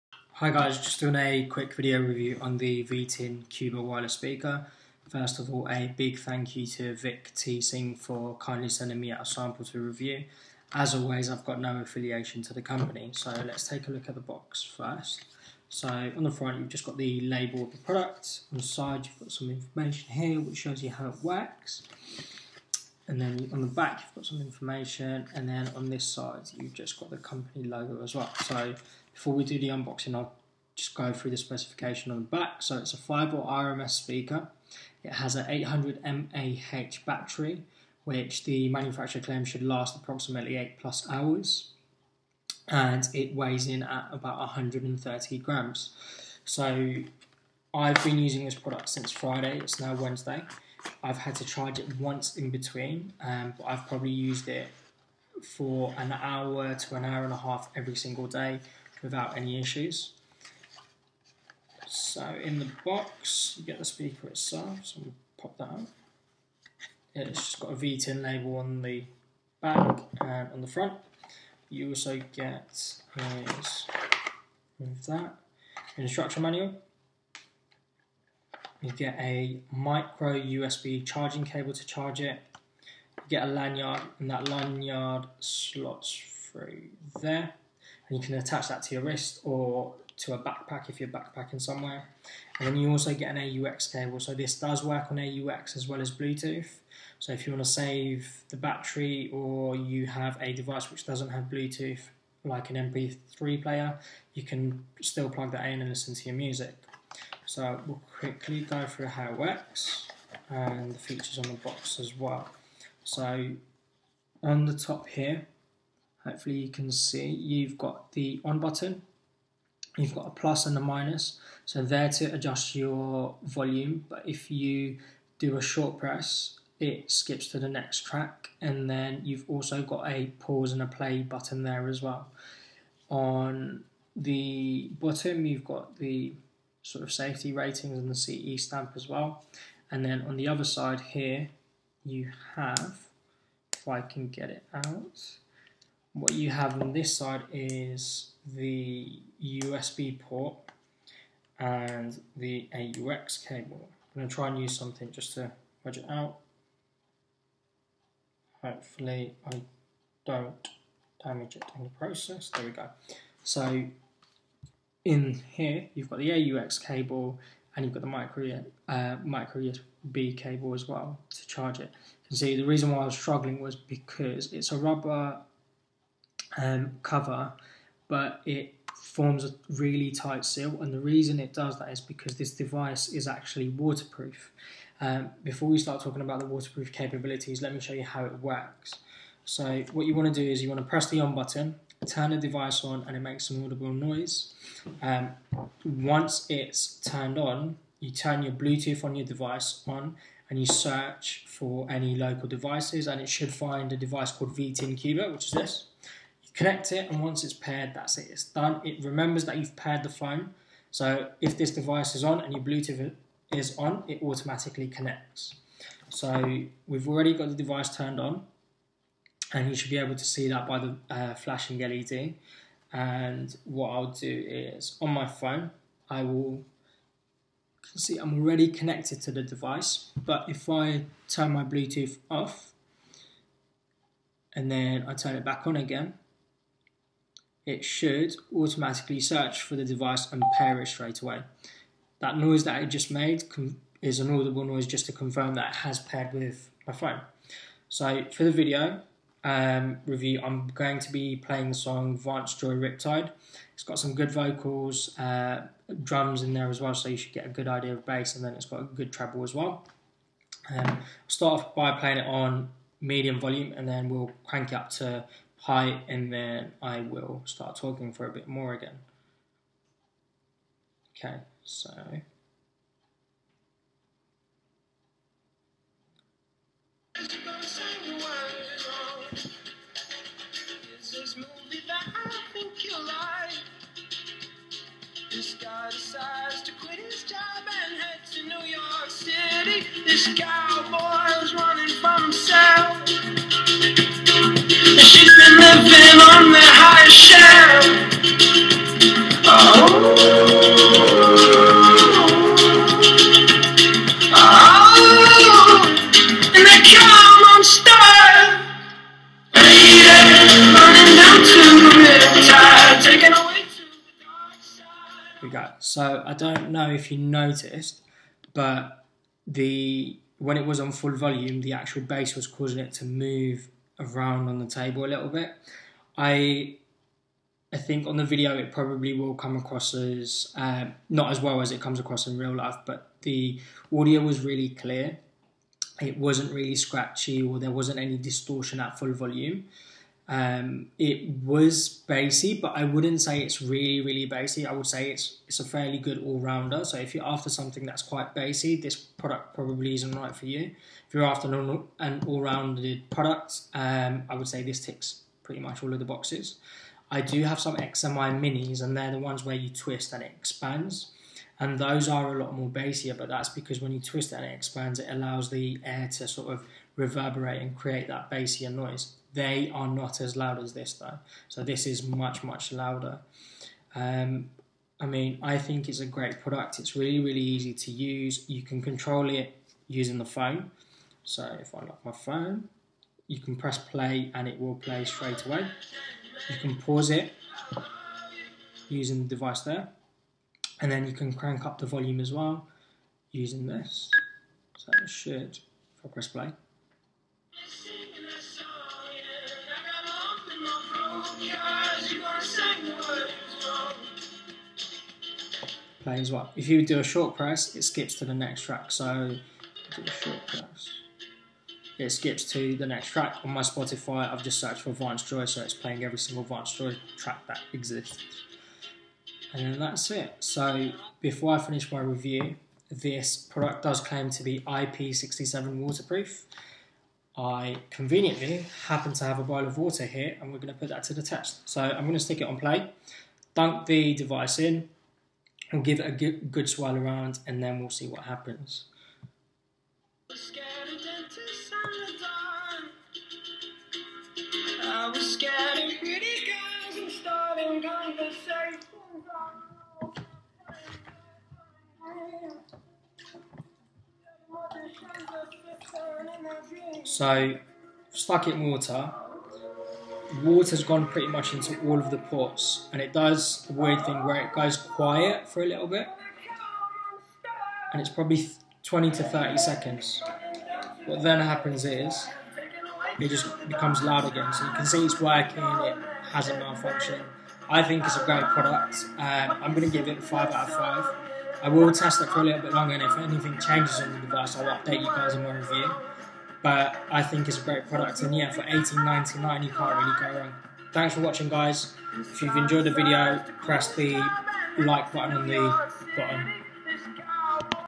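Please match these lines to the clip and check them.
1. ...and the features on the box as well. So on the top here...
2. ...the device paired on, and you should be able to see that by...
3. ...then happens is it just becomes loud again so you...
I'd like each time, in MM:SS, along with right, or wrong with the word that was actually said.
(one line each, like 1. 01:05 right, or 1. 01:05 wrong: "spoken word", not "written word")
1. 01:50 right
2. 03:37 wrong: "turned", not "paired"
3. 07:51 right.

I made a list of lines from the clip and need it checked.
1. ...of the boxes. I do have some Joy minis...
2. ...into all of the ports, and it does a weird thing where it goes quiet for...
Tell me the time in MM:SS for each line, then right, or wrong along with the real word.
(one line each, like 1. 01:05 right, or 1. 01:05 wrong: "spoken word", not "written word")
1. 05:55 wrong: "XMI", not "Joy"
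2. 07:41 right.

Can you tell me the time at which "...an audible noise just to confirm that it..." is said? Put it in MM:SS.
04:04.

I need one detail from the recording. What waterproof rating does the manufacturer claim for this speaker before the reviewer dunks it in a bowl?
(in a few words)
IP67.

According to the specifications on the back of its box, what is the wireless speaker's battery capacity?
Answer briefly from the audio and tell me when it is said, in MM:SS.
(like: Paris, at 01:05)
800 mAh, at 00:35.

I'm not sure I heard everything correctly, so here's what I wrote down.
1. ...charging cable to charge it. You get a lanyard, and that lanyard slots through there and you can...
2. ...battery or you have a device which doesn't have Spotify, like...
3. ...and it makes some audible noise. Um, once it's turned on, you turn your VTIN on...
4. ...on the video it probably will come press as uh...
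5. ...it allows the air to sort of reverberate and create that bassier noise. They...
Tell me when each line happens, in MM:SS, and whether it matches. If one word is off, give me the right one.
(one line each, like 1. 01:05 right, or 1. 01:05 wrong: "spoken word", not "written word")
1. 01:21 right
2. 01:38 wrong: "Bluetooth", not "Spotify"
3. 03:13 wrong: "Bluetooth", not "VTIN"
4. 05:28 wrong: "across", not "press"
5. 06:04 right.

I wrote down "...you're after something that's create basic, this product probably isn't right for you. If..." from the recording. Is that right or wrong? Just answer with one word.
wrong.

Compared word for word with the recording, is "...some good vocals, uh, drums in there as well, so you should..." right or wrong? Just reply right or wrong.
right.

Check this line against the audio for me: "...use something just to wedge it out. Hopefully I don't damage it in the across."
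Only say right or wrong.
wrong.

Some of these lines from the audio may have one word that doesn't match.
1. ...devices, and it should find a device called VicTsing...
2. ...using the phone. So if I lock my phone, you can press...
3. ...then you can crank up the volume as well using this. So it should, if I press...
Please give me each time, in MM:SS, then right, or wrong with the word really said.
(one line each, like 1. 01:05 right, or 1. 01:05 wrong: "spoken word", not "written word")
1. 03:22 wrong: "VTIN", not "VicTsing"
2. 06:19 right
3. 06:30 right.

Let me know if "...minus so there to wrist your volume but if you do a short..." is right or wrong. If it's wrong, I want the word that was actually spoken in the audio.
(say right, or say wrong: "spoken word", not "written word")
wrong: "adjust", not "wrist".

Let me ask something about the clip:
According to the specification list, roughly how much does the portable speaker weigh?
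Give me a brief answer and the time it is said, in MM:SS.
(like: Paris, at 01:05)
130 grams, at 00:44.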